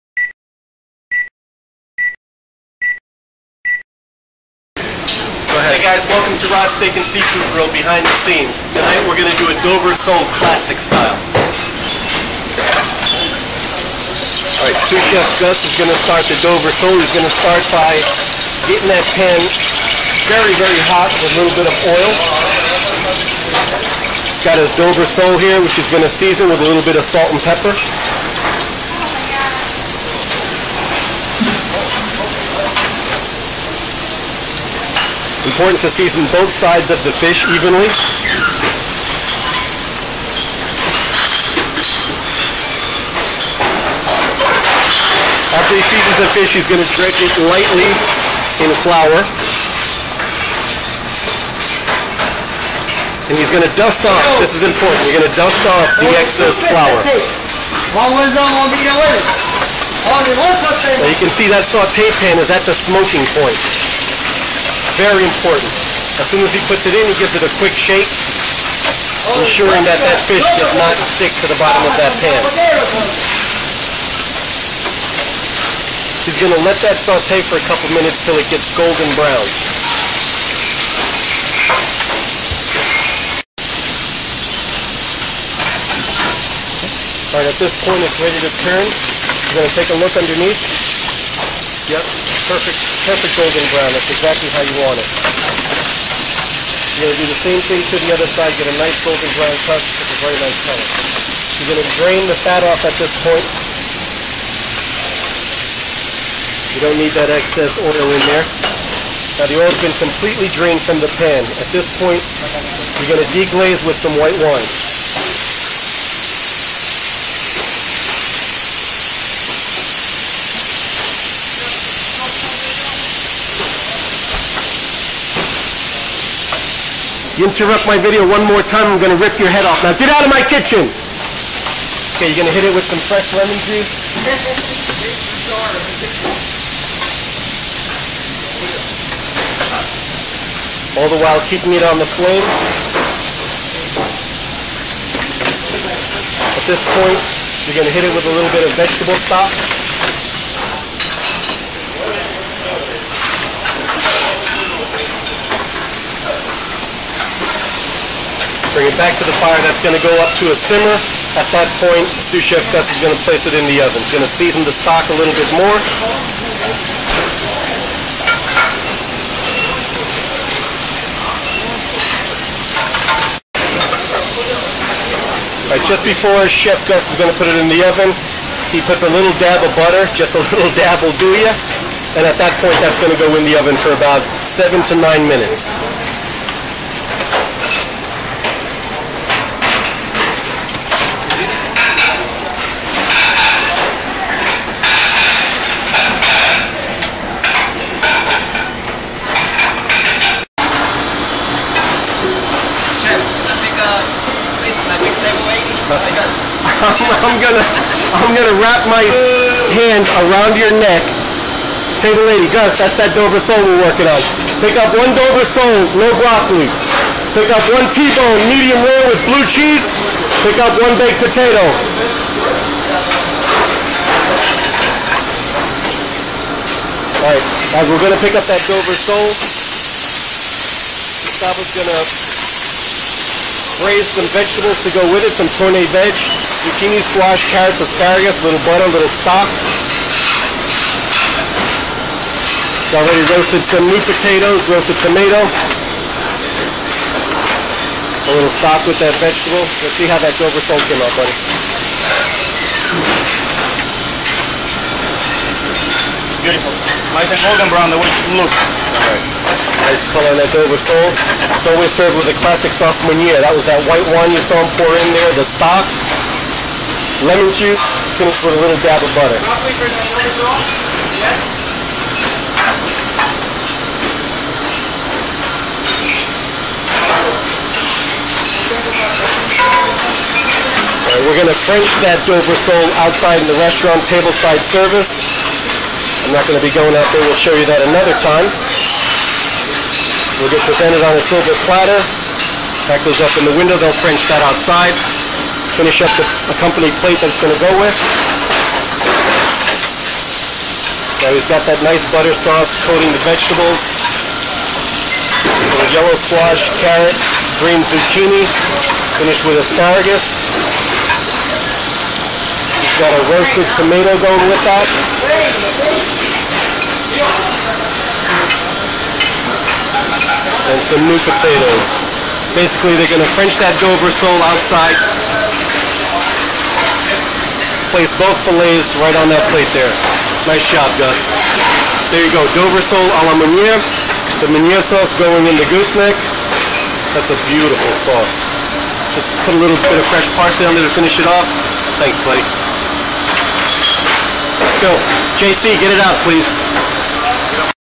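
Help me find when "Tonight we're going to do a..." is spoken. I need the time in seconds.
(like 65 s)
8 s.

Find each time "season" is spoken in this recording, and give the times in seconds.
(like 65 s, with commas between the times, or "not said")
26 s, 35 s, 45 s, 164 s.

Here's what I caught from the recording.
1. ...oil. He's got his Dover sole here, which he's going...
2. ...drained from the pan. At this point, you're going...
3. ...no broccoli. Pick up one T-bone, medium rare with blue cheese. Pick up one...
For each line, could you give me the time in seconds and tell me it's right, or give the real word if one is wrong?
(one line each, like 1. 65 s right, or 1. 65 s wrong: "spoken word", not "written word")
1. 21 s right
2. 110 s right
3. 215 s right.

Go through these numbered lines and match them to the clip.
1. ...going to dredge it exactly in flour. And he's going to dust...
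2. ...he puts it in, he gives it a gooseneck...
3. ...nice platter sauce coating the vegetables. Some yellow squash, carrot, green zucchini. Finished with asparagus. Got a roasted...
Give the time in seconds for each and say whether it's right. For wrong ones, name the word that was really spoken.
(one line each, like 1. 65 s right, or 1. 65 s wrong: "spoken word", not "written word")
1. 46 s wrong: "lightly", not "exactly"
2. 66 s wrong: "quick", not "gooseneck"
3. 301 s wrong: "butter", not "platter".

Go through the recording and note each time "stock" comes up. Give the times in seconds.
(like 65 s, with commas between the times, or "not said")
149 s, 164 s, 239 s, 248 s, 265 s.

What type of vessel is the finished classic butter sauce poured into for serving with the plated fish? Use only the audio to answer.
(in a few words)
gooseneck.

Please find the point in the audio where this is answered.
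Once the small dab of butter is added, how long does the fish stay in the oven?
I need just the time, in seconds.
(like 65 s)
184 s.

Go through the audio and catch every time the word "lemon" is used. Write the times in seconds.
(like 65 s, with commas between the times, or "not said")
133 s, 267 s.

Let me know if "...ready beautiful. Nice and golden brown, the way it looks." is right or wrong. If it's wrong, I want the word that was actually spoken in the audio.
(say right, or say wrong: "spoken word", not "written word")
wrong: "buddy", not "ready".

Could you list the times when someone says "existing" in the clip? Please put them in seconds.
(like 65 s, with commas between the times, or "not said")
not said.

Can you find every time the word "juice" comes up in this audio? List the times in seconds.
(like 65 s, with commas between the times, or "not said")
133 s, 267 s.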